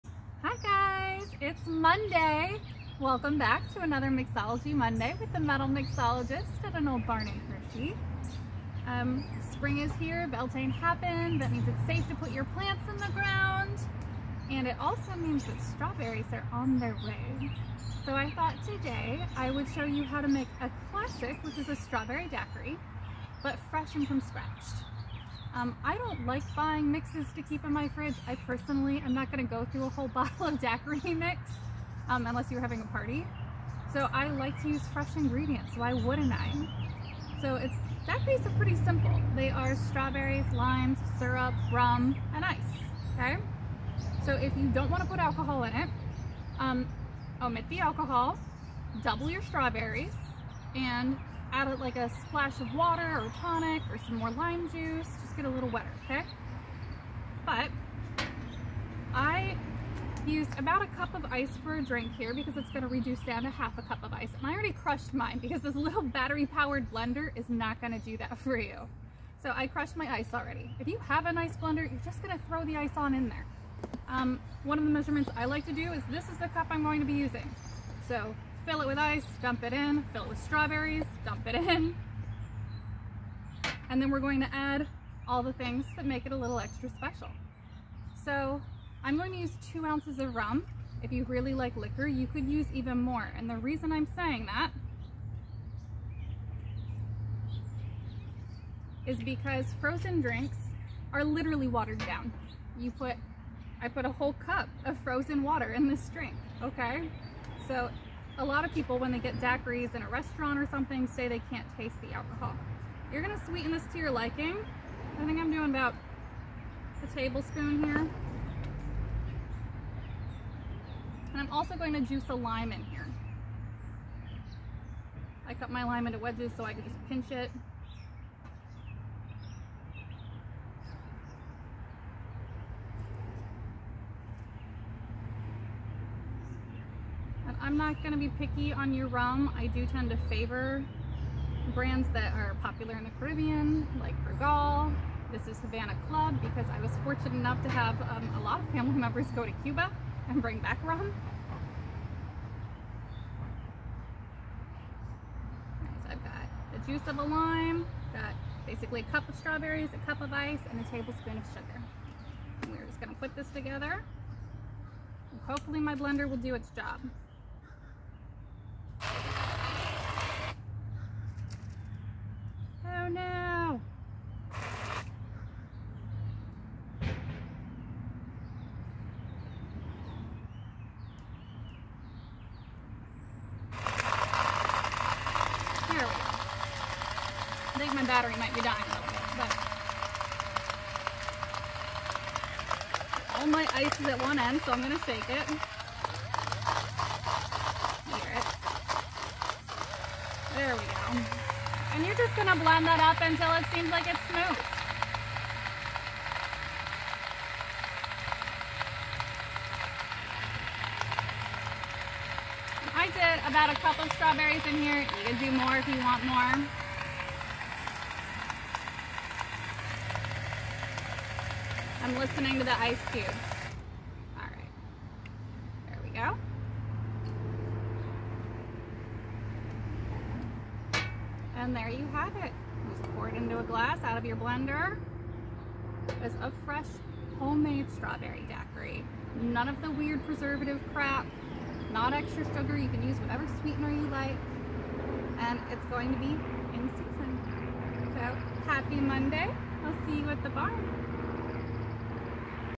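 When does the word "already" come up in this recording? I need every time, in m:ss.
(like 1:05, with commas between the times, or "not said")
1:04, 1:10.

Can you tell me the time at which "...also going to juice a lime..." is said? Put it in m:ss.
2:01.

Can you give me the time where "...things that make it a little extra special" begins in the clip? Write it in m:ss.
1:25.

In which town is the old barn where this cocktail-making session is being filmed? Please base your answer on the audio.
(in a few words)
Hershey.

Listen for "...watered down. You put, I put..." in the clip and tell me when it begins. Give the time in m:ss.
1:41.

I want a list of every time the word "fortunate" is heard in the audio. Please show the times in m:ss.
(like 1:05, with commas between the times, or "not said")
2:27.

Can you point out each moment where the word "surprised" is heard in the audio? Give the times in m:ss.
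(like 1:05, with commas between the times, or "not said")
not said.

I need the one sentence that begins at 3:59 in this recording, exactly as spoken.
None of the weird preservative crap, not extra sugar.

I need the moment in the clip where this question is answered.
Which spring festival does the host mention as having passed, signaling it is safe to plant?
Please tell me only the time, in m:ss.
0:10.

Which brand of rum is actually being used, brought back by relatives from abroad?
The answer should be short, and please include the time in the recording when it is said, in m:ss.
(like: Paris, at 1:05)
Havana Club, at 2:25.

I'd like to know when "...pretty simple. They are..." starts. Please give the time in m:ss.
0:38.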